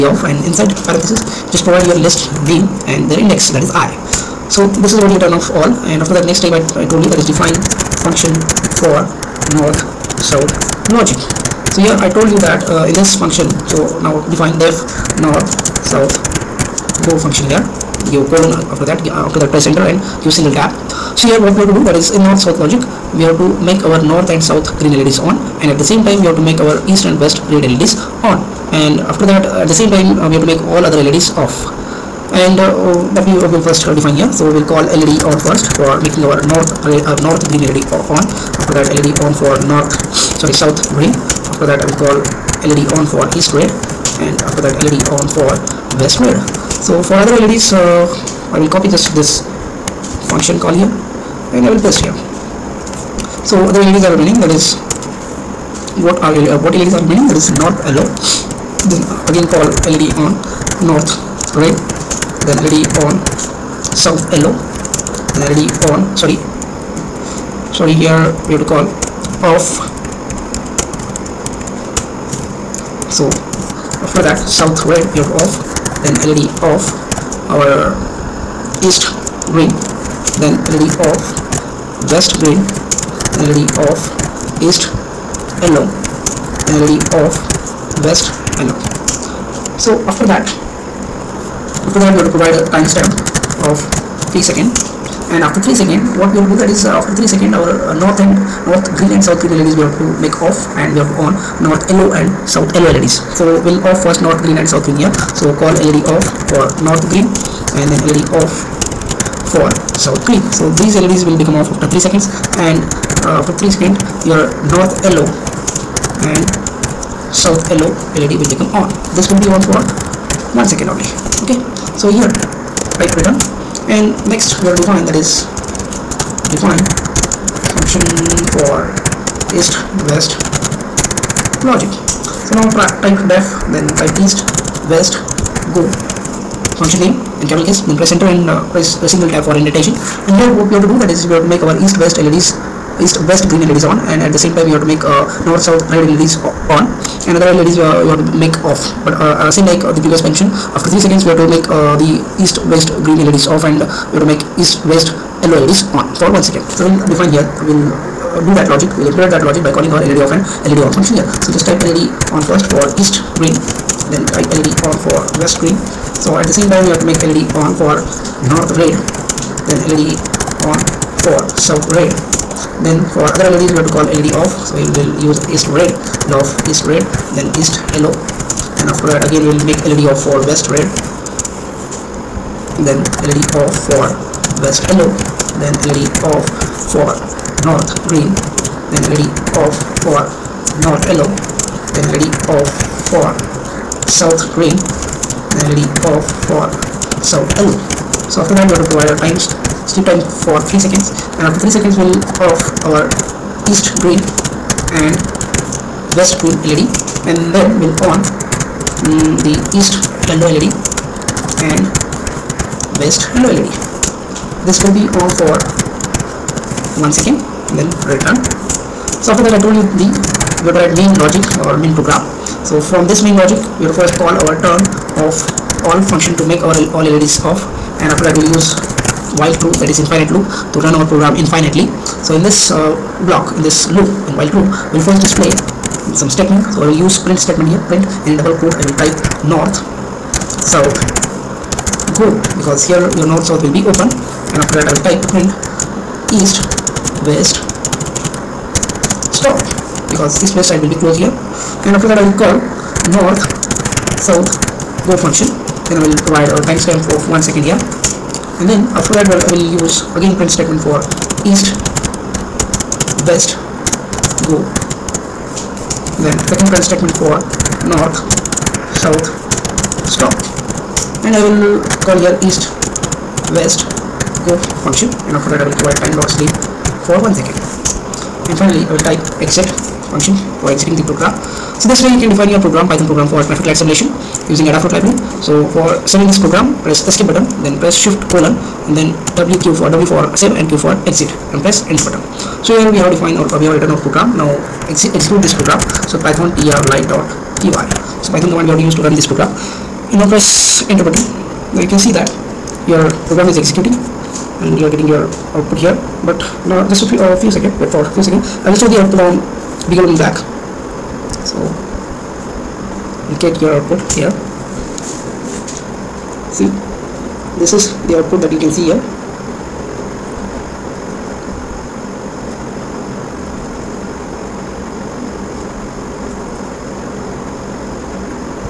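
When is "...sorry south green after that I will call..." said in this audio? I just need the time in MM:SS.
00:40.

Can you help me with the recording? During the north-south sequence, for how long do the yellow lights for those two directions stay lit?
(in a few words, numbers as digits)
1 second.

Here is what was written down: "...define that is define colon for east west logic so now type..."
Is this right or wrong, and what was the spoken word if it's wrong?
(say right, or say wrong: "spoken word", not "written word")
wrong: "function", not "colon".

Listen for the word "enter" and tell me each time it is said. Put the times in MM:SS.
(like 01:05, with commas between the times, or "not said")
00:19, 02:18, 04:51, 05:00.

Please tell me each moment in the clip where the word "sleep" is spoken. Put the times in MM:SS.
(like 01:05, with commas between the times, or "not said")
03:19, 04:36.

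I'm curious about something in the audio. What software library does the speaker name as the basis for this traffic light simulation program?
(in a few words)
Adafruit.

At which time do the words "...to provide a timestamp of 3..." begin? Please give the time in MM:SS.
01:32.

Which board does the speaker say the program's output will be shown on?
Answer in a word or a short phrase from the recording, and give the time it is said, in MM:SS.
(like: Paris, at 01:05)
BeagleBone Black, at 05:09.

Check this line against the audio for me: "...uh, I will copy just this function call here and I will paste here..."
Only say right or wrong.
right.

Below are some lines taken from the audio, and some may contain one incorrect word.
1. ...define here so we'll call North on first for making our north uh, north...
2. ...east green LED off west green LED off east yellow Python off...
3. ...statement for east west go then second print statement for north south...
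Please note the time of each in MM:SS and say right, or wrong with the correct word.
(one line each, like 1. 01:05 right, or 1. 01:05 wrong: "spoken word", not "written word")
1. 00:33 wrong: "LED", not "North"
2. 01:18 wrong: "LED", not "Python"
3. 04:20 right.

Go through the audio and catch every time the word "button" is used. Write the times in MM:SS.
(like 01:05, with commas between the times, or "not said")
04:47, 04:52, 05:01.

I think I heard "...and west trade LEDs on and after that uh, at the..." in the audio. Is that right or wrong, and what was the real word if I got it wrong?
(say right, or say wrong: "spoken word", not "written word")
right.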